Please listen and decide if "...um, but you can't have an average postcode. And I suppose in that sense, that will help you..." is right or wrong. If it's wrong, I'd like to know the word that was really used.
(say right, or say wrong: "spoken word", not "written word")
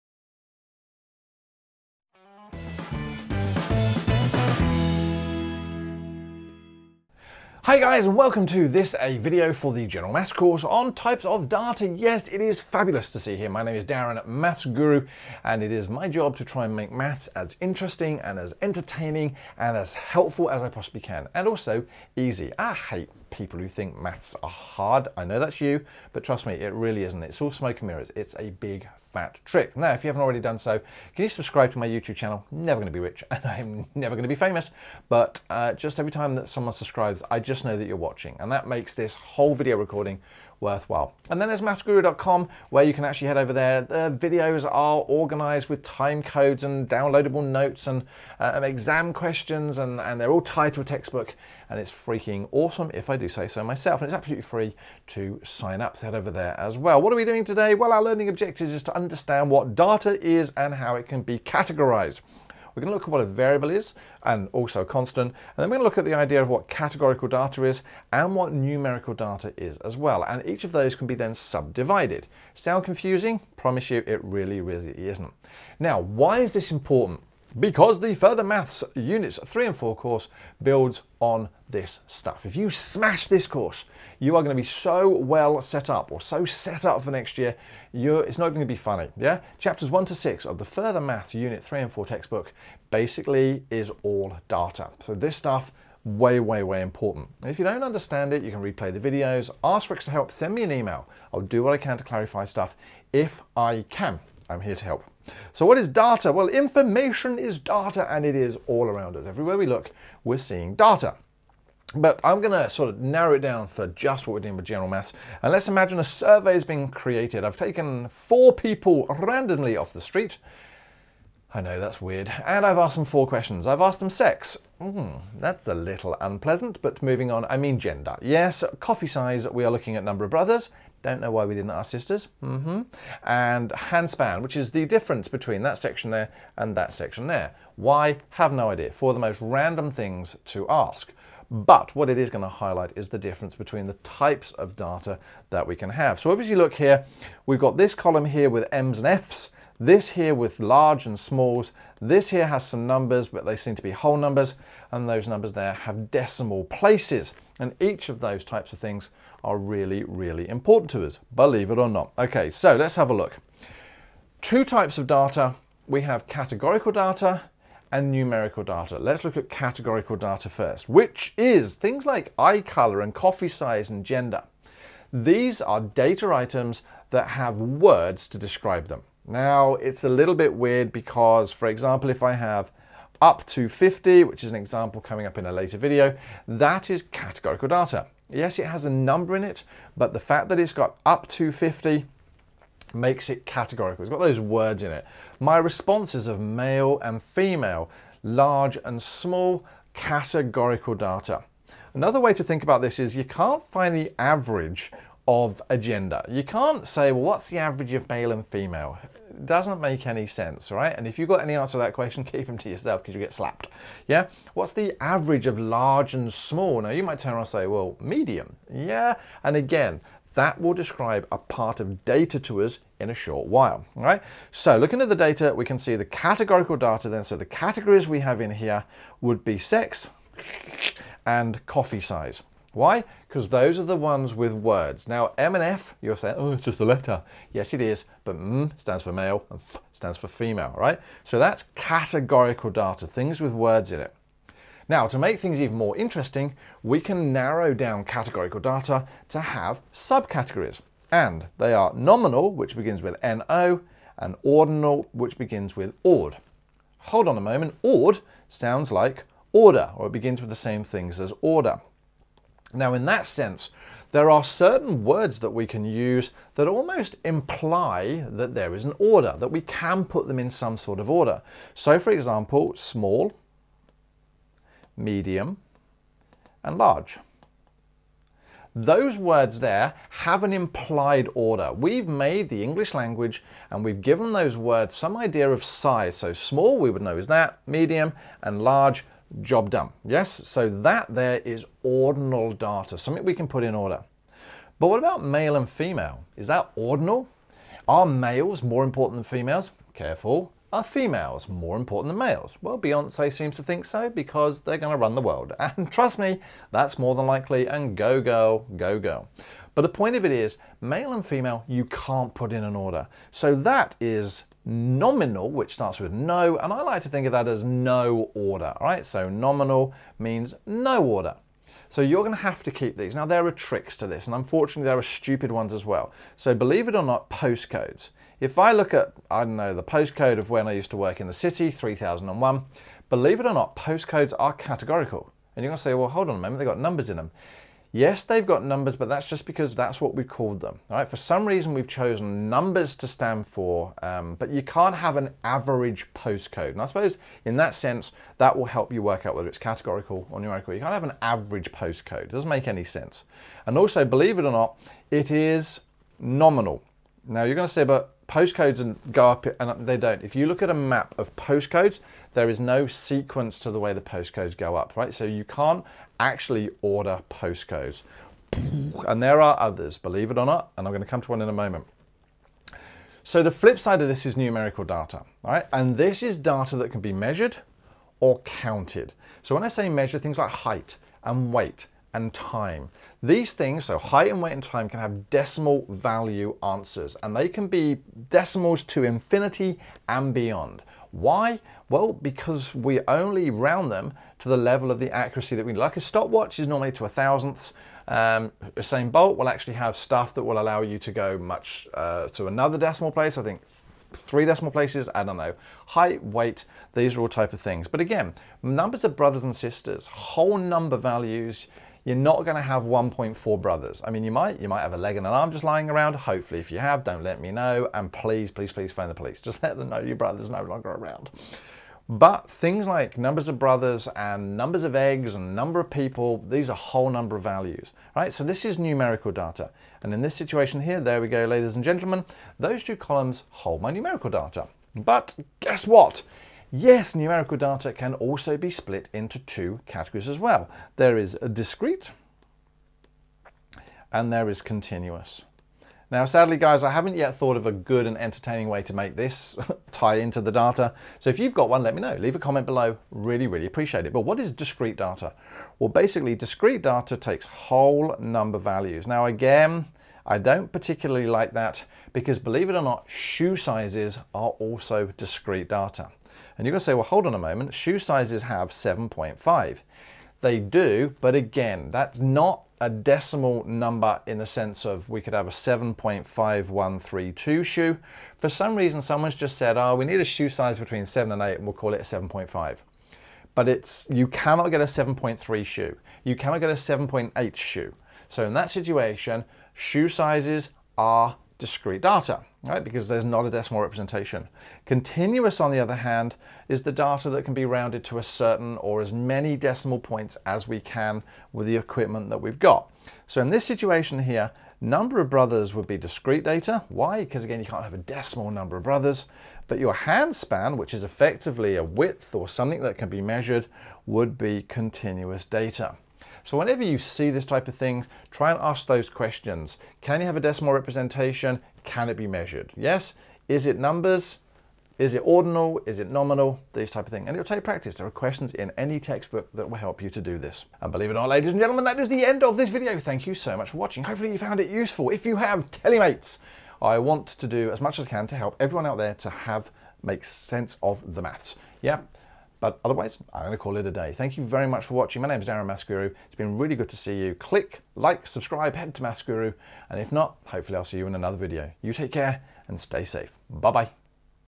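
right.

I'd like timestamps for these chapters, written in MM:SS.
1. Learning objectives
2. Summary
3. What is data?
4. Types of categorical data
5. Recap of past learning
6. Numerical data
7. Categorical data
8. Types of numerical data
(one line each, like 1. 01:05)
1. 00:57
2. 08:50
3. 01:37
4. 04:03
5. 01:13
6. 06:12
7. 02:42
8. 07:16.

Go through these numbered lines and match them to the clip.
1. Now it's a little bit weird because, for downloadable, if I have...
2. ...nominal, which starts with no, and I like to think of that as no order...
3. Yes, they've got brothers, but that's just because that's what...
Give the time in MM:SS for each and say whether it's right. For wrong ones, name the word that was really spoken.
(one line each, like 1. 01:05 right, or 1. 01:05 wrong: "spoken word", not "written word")
1. 02:59 wrong: "example", not "downloadable"
2. 05:14 right
3. 05:37 wrong: "numbers", not "brothers".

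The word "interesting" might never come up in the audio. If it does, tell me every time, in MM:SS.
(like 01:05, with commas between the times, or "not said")
00:17, 04:05.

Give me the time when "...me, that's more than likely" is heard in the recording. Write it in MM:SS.
05:06.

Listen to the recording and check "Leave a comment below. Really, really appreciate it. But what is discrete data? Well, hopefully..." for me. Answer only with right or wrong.
wrong.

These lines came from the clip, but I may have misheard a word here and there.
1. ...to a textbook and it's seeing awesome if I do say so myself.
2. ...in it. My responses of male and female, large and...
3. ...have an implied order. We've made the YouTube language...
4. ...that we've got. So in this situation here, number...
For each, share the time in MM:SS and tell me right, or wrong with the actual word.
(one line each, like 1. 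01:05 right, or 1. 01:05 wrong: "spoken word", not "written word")
1. 00:50 wrong: "freaking", not "seeing"
2. 03:14 right
3. 04:40 wrong: "English", not "YouTube"
4. 08:22 right.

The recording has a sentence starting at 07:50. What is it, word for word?
They do, but again, that's not a decimal number in the sense of we could have a 7.5132 shoe.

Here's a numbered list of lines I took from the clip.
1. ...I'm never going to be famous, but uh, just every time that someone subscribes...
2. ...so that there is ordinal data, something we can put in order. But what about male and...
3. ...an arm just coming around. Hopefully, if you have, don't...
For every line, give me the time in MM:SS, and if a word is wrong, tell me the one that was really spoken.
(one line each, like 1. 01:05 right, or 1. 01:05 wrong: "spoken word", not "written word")
1. 00:33 right
2. 04:50 right
3. 06:55 wrong: "lying", not "coming".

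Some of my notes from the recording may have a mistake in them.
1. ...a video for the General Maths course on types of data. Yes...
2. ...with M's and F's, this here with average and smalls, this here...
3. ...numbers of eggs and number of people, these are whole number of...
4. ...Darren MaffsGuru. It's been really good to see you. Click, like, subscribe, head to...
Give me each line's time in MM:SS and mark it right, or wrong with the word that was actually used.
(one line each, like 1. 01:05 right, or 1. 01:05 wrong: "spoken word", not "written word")
1. 00:08 right
2. 02:28 wrong: "large", not "average"
3. 07:04 right
4. 09:05 right.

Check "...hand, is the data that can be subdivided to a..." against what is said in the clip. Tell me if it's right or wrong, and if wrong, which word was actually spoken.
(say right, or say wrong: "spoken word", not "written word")
wrong: "rounded", not "subdivided".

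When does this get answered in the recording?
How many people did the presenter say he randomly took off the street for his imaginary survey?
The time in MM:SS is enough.
01:58.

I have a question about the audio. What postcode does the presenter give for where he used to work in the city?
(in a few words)
3001.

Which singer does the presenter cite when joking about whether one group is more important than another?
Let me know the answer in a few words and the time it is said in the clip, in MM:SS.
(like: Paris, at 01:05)
Beyonce, at 05:02.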